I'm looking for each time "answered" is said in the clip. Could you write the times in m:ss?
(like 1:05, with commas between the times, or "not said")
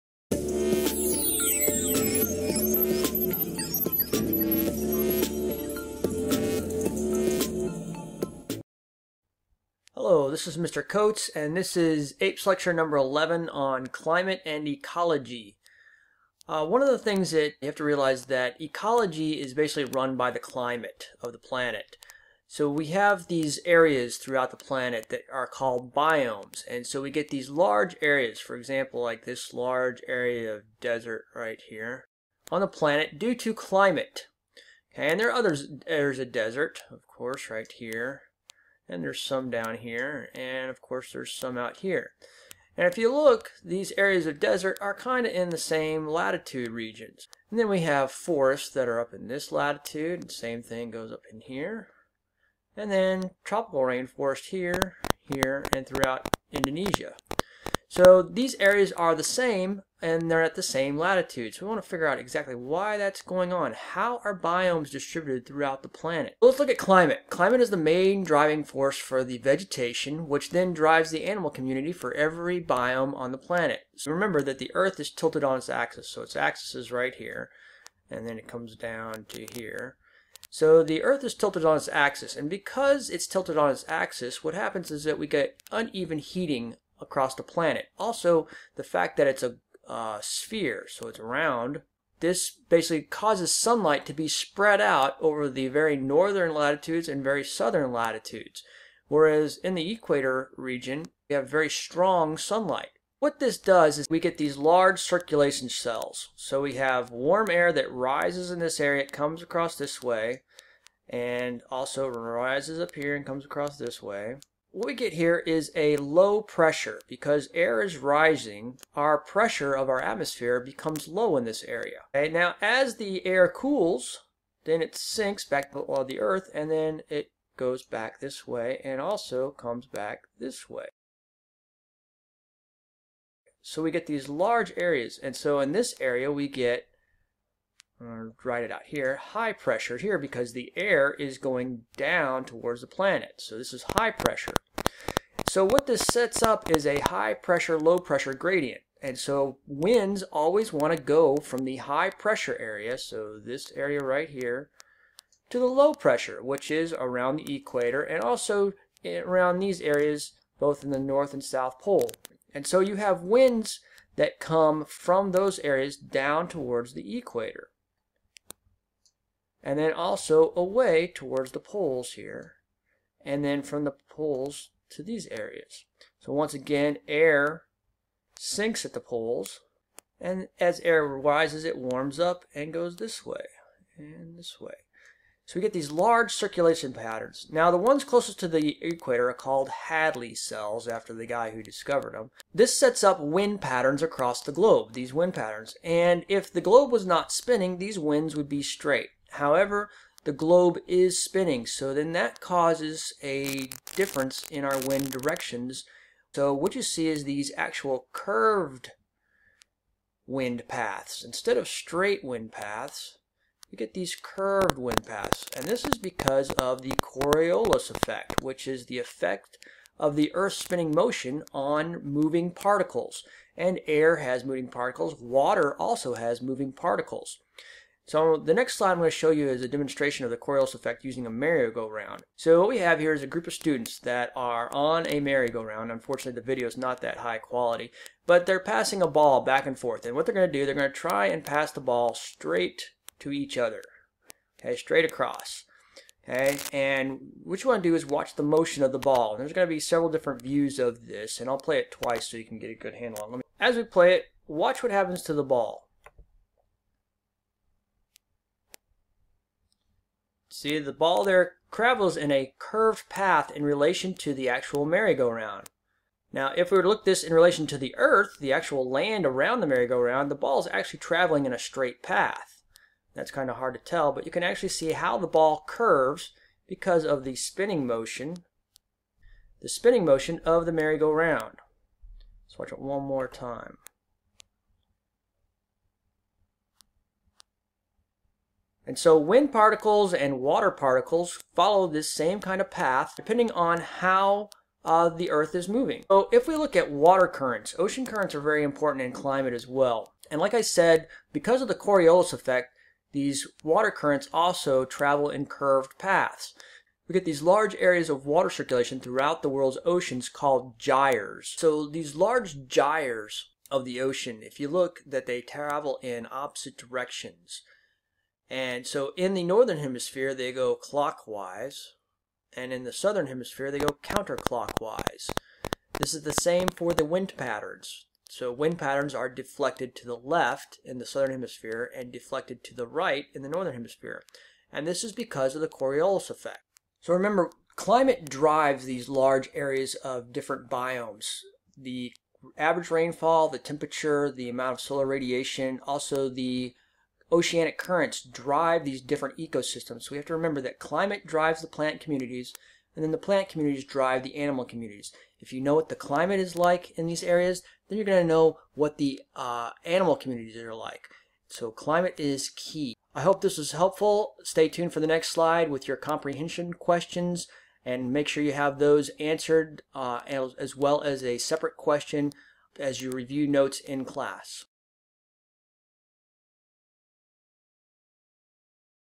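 6:09.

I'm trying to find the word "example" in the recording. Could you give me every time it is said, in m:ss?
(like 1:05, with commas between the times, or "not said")
0:28.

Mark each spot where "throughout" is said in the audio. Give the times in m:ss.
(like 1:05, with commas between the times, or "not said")
0:24, 0:55, 1:05, 5:08.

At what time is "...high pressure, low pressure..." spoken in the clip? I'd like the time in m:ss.
2:27.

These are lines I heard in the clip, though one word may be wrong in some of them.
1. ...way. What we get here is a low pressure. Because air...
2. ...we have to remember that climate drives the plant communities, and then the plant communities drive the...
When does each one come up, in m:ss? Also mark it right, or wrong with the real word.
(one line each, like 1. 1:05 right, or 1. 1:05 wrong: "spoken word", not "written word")
1. 1:54 right
2. 5:50 right.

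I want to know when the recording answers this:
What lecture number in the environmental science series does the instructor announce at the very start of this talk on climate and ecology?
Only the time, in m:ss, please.
0:12.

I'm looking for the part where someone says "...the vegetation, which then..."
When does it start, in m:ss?
1:09.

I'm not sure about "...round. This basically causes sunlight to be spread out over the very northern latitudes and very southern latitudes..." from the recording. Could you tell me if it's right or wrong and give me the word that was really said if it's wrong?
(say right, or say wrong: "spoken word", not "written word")
right.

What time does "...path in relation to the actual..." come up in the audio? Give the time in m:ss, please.
4:23.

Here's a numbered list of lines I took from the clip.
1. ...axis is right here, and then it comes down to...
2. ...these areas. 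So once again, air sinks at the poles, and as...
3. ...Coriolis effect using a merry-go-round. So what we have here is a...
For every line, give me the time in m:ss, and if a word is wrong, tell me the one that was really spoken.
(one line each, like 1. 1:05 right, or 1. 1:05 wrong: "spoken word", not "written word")
1. 1:16 right
2. 2:55 right
3. 3:50 right.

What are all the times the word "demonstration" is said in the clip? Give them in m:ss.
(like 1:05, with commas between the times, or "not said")
3:49.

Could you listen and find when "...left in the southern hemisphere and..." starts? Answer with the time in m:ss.
5:30.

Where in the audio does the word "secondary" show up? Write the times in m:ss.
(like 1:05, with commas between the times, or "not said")
not said.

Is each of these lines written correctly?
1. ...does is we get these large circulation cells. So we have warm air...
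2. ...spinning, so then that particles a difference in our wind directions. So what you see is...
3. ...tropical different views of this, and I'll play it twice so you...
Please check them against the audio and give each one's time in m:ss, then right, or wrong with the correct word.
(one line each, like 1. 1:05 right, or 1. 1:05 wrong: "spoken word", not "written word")
1. 1:43 right
2. 3:21 wrong: "causes", not "particles"
3. 4:09 wrong: "several", not "tropical".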